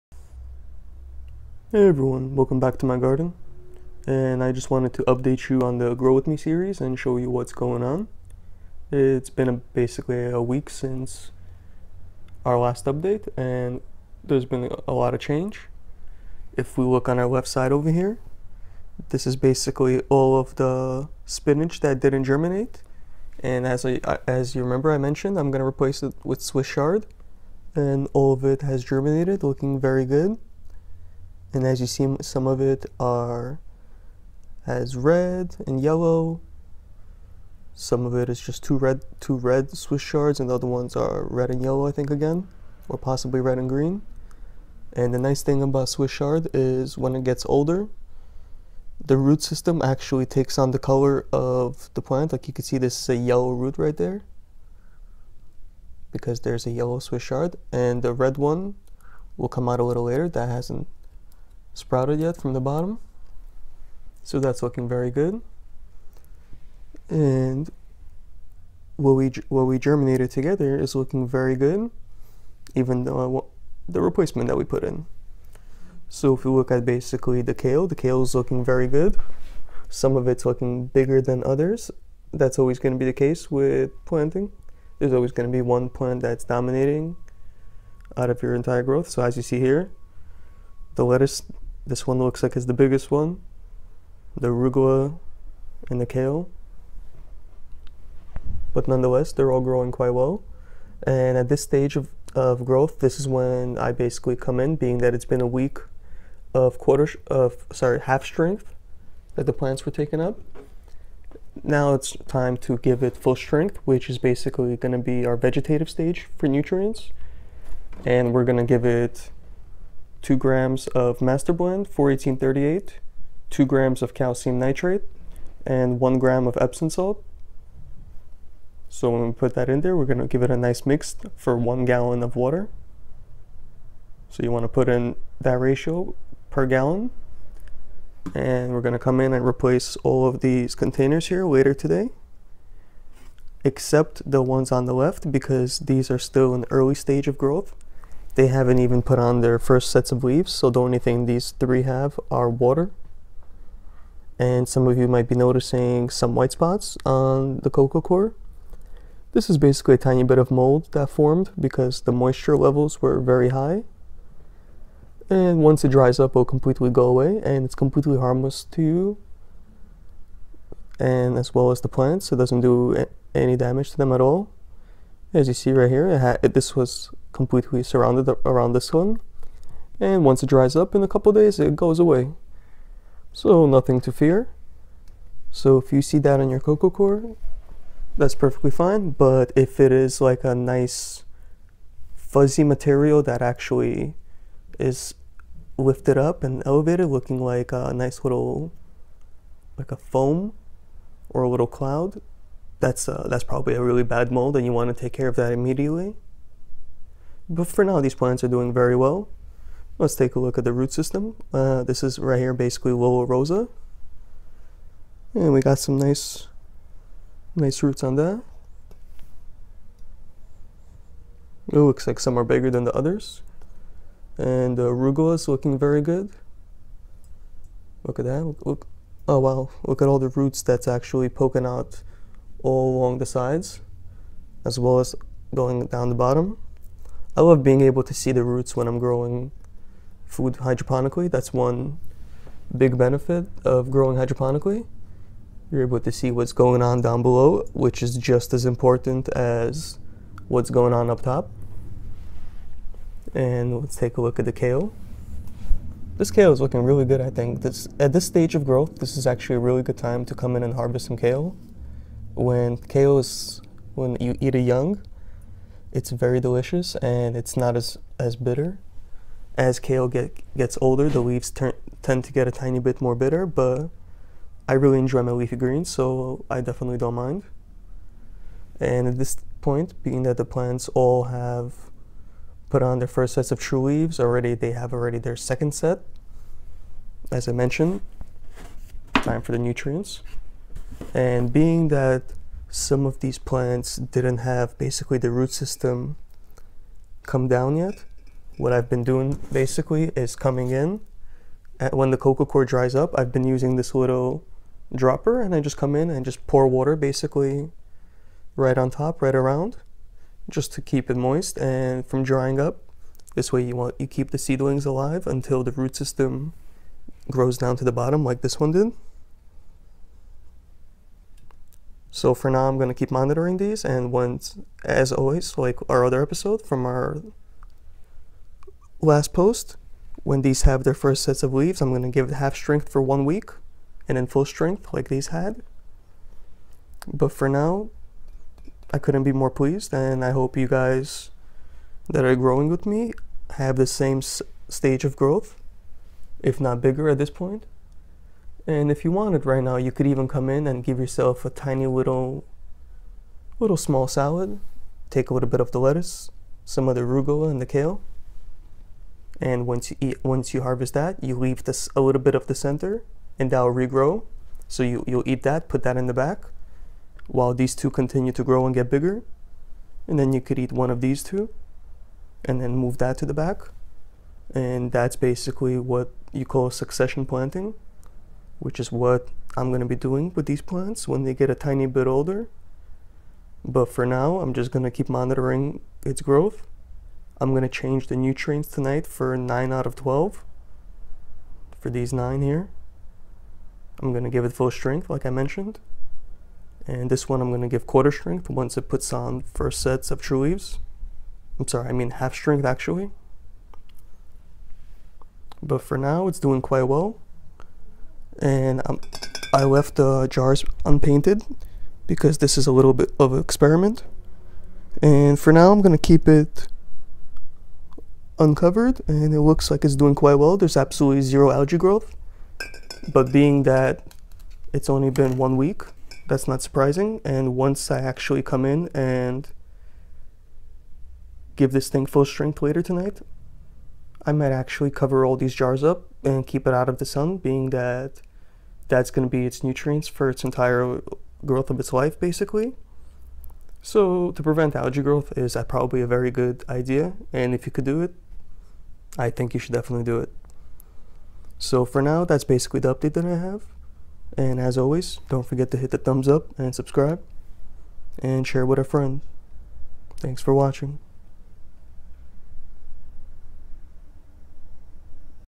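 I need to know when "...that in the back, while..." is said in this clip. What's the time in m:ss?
6:05.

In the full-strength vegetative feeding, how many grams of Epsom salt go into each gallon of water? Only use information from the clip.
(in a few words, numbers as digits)
1 gram.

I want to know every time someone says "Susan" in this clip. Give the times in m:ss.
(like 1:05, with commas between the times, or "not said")
not said.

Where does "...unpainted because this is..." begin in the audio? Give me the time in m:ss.
6:50.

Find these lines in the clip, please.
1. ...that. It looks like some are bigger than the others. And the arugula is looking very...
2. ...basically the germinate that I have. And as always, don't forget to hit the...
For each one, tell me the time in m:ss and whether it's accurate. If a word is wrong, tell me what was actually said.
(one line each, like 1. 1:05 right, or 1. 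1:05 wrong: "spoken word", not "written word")
1. 3:38 right
2. 7:32 wrong: "update", not "germinate".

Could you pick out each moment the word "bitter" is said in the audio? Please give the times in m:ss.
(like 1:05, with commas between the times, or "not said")
4:28, 4:33.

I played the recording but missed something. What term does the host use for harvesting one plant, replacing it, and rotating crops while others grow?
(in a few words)
succession planting.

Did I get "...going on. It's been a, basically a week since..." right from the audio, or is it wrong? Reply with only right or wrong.
right.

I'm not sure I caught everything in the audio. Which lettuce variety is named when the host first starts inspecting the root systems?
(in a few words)
Lollo Rossa.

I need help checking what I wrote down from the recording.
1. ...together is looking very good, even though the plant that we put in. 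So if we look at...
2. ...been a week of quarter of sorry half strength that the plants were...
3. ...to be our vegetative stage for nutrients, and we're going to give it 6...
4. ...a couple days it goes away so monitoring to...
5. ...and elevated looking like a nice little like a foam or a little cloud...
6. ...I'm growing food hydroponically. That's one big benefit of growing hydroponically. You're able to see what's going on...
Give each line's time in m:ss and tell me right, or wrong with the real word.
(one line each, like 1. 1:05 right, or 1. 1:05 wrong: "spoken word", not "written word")
1. 1:10 wrong: "replacement", not "plant"
2. 1:45 right
3. 1:54 wrong: "2", not "6"
4. 3:01 wrong: "nothing", not "monitoring"
5. 3:16 right
6. 3:58 right.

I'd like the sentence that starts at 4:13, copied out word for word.
And let's take a look at the kale.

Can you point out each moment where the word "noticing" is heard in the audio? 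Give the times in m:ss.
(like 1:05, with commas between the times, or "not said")
2:35.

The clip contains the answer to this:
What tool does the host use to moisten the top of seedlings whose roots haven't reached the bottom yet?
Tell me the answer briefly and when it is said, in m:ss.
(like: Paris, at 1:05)
dropper, at 5:04.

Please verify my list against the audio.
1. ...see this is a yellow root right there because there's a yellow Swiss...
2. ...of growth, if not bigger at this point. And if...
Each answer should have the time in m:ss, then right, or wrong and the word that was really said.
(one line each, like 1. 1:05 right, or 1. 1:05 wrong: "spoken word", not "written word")
1. 0:52 right
2. 5:45 right.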